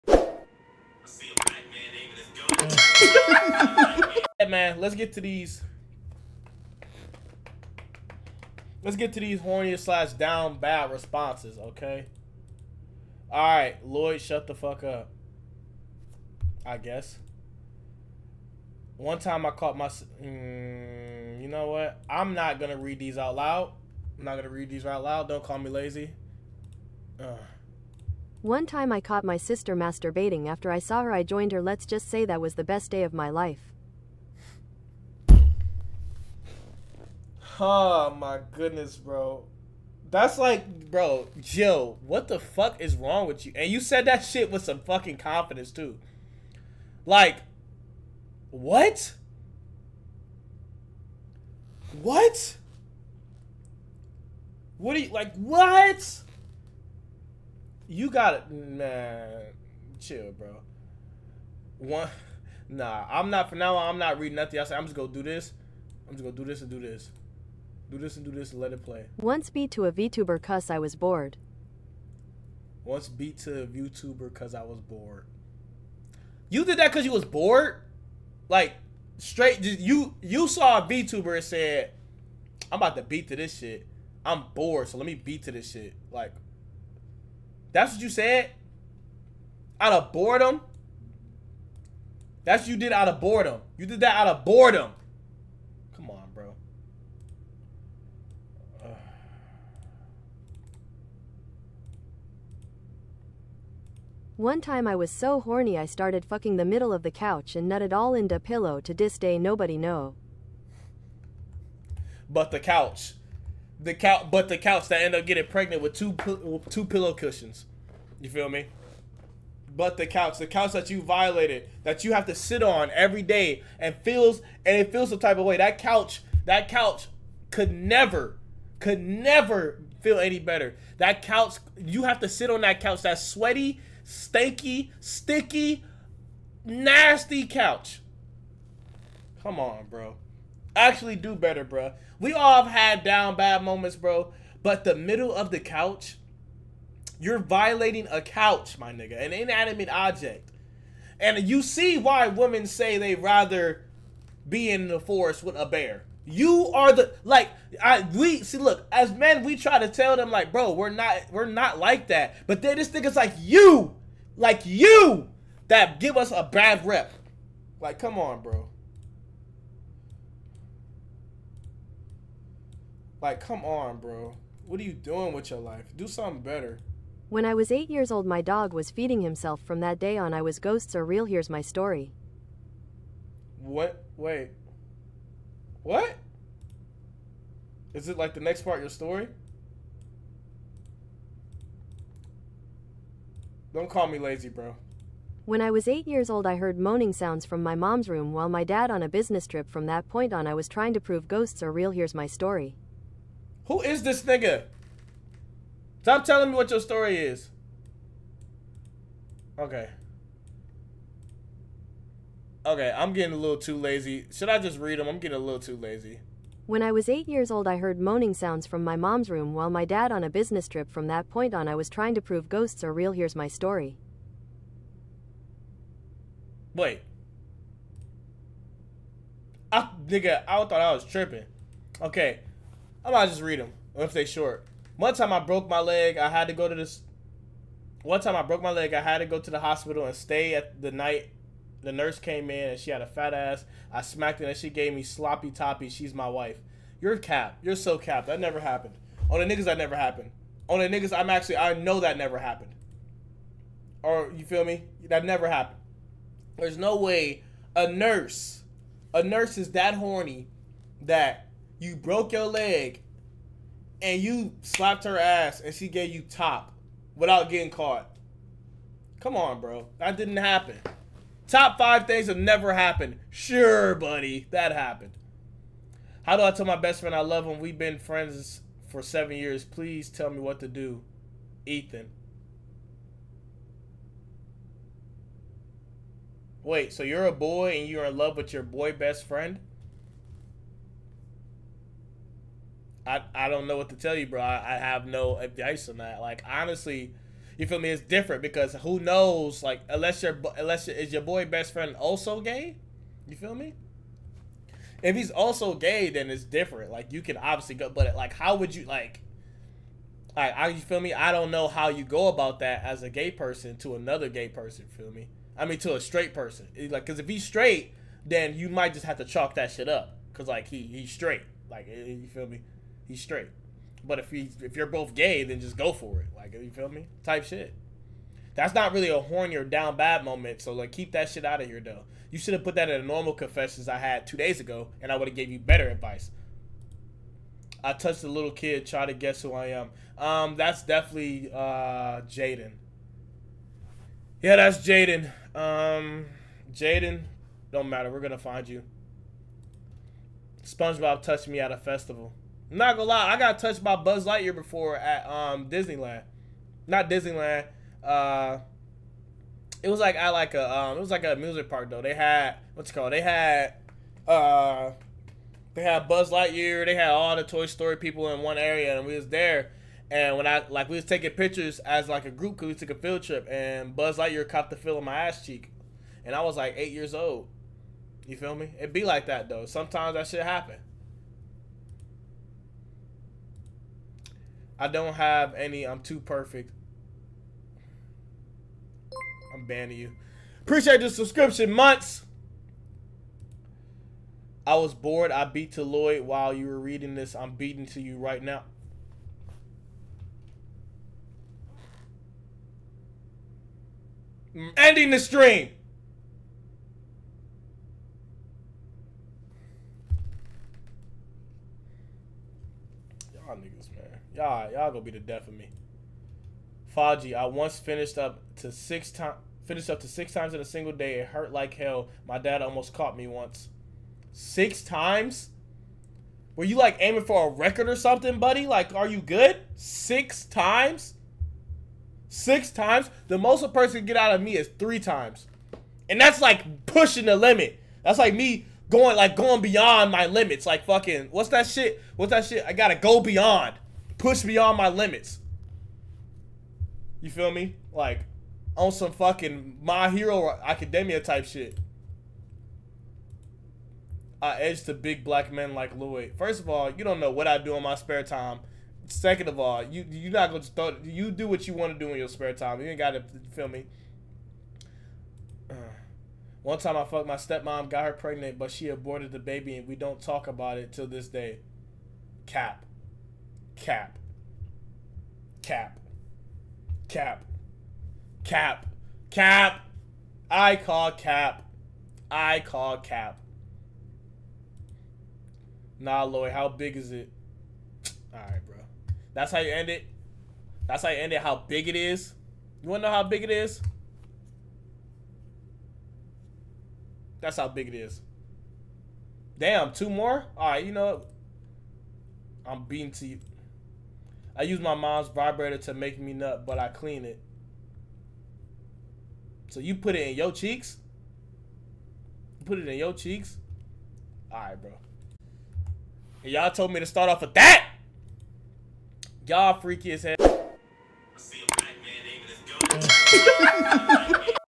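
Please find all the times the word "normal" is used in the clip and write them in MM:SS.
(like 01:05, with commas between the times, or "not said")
05:33.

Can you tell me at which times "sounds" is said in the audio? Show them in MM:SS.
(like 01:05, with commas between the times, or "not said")
03:17, 03:38.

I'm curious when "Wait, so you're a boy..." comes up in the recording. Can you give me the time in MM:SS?
04:46.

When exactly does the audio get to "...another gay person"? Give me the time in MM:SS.
05:13.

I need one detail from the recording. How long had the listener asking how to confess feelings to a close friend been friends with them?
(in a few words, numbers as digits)
7 years.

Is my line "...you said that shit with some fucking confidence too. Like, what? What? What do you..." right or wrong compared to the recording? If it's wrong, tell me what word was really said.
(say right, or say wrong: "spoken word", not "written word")
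right.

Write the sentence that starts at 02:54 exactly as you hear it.
What are you doing with your life?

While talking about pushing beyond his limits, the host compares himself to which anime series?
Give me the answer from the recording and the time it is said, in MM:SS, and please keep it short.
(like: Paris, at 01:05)
My Hero Academia, at 07:29.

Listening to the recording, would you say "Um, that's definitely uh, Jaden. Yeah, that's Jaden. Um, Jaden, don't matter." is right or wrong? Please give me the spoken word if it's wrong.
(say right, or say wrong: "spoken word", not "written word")
right.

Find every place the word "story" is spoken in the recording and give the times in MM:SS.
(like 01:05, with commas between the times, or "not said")
03:01, 03:08, 03:22, 03:26, 03:43, 06:07.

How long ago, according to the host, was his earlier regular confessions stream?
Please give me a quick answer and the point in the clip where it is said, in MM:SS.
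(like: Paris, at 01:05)
2 days ago, at 05:34.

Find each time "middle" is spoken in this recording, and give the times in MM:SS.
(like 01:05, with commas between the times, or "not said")
01:46, 02:24.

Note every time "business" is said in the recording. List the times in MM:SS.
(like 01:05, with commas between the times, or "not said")
03:19, 03:40.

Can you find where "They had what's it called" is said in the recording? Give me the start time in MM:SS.
06:02.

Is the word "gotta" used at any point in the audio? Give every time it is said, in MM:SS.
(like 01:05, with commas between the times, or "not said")
07:22, 07:42.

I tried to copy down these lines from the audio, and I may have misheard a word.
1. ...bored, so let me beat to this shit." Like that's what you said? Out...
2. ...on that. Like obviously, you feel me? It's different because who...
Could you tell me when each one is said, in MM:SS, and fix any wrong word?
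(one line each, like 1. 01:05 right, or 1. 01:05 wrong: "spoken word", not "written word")
1. 01:24 right
2. 04:55 wrong: "honestly", not "obviously".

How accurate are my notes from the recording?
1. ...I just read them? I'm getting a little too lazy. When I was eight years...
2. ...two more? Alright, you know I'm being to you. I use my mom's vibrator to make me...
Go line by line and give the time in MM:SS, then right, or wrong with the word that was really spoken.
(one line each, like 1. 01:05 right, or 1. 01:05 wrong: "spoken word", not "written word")
1. 03:34 right
2. 08:19 right.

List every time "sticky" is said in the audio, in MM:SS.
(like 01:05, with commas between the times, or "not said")
02:14.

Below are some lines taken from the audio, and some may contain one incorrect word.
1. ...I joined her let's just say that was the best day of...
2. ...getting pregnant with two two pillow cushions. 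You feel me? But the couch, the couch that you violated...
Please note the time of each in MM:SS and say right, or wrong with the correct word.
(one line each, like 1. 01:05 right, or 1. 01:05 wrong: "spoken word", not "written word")
1. 00:31 right
2. 01:55 right.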